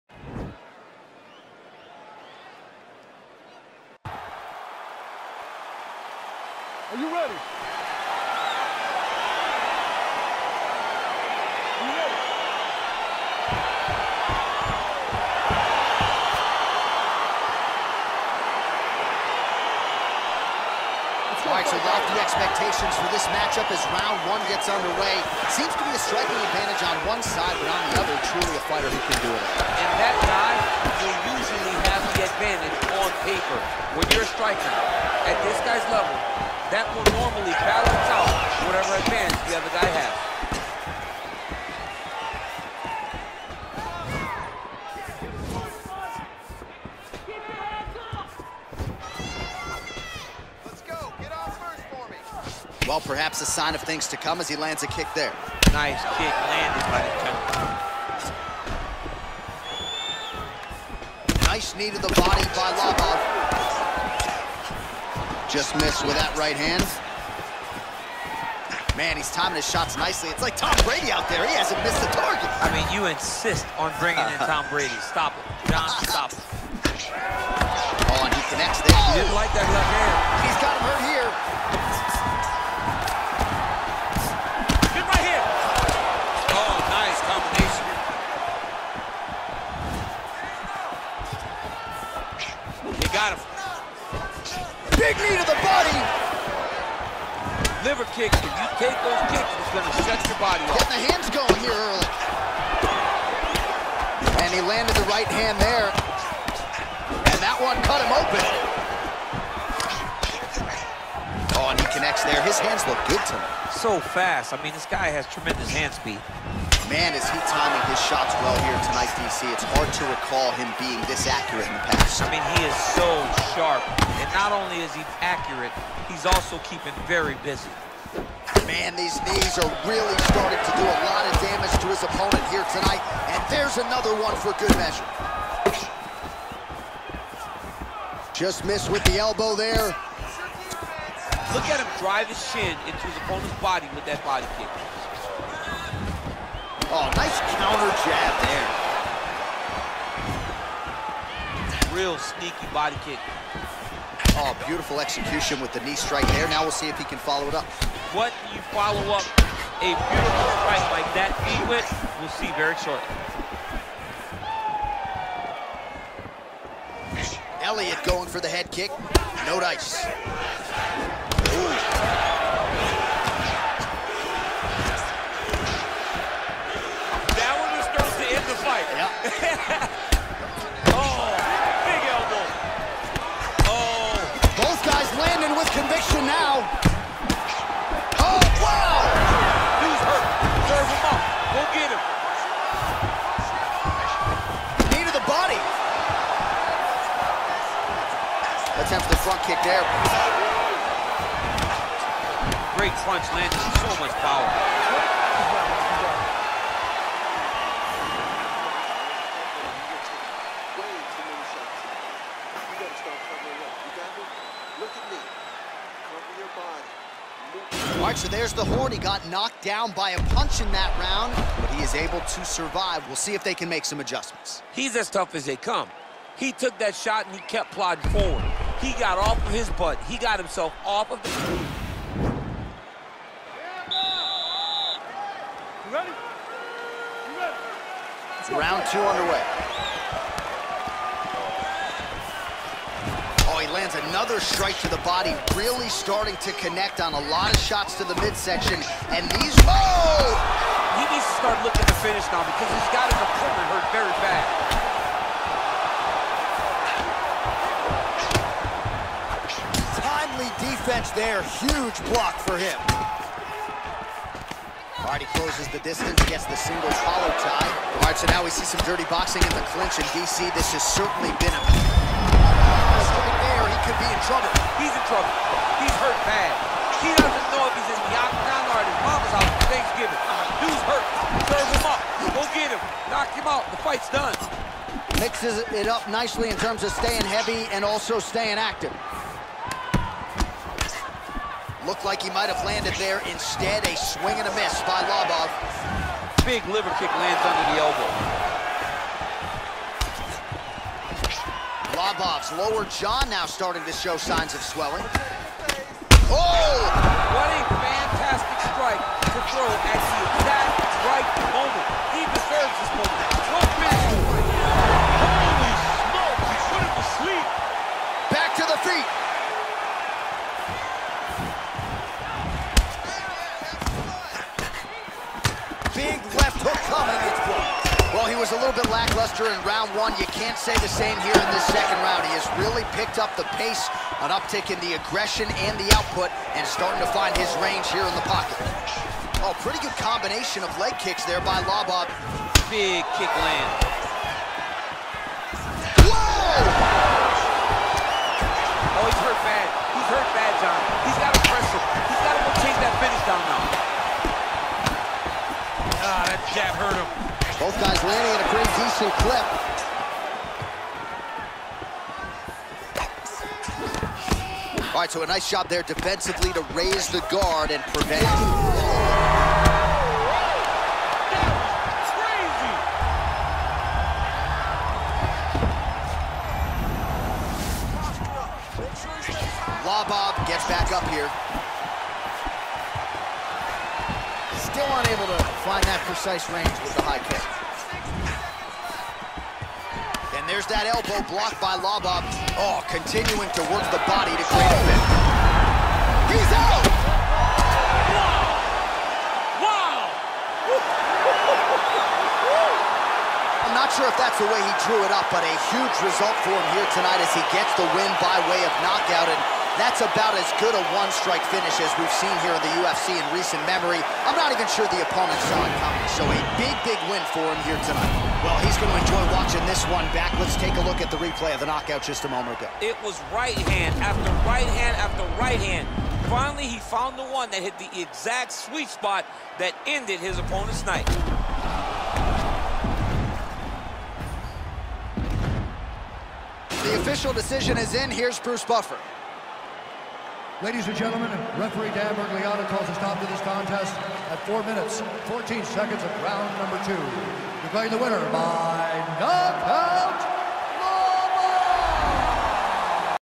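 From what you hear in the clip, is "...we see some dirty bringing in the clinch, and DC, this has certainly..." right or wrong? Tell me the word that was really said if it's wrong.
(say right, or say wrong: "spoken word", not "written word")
wrong: "boxing", not "bringing".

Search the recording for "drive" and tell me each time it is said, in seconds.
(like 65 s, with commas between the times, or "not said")
141 s.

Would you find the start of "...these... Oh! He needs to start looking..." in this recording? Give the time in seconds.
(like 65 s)
249 s.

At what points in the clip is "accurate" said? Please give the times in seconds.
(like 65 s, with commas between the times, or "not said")
121 s, 125 s.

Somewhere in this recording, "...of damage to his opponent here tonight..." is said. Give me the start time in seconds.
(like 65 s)
131 s.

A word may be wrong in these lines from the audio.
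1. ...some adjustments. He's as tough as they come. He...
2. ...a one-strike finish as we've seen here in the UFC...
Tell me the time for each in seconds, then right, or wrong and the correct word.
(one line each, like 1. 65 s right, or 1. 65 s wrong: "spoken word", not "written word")
1. 223 s right
2. 410 s right.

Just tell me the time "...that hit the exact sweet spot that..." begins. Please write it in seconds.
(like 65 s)
427 s.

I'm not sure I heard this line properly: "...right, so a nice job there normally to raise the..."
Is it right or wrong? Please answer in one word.
wrong.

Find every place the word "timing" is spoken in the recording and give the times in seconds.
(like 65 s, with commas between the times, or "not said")
69 s, 117 s.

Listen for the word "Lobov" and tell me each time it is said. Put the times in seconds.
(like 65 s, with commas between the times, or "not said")
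62 s, 295 s, 301 s, 341 s, 379 s, 391 s.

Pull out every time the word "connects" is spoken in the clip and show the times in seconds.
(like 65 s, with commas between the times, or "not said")
78 s, 111 s, 246 s.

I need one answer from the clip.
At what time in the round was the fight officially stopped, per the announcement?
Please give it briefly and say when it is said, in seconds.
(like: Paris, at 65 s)
4:14, at 444 s.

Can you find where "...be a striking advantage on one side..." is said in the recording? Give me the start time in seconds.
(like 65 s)
25 s.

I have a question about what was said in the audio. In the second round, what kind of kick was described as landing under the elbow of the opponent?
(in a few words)
Liver kick.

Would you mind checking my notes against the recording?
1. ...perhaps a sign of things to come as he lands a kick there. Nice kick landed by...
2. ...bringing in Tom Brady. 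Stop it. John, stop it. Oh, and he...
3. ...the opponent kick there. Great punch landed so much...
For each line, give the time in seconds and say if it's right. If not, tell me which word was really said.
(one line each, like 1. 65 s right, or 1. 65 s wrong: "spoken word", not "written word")
1. 53 s right
2. 73 s right
3. 199 s wrong: "front", not "opponent".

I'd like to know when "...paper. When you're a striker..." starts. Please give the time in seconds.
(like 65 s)
33 s.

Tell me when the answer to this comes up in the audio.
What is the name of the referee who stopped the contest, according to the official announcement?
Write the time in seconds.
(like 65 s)
441 s.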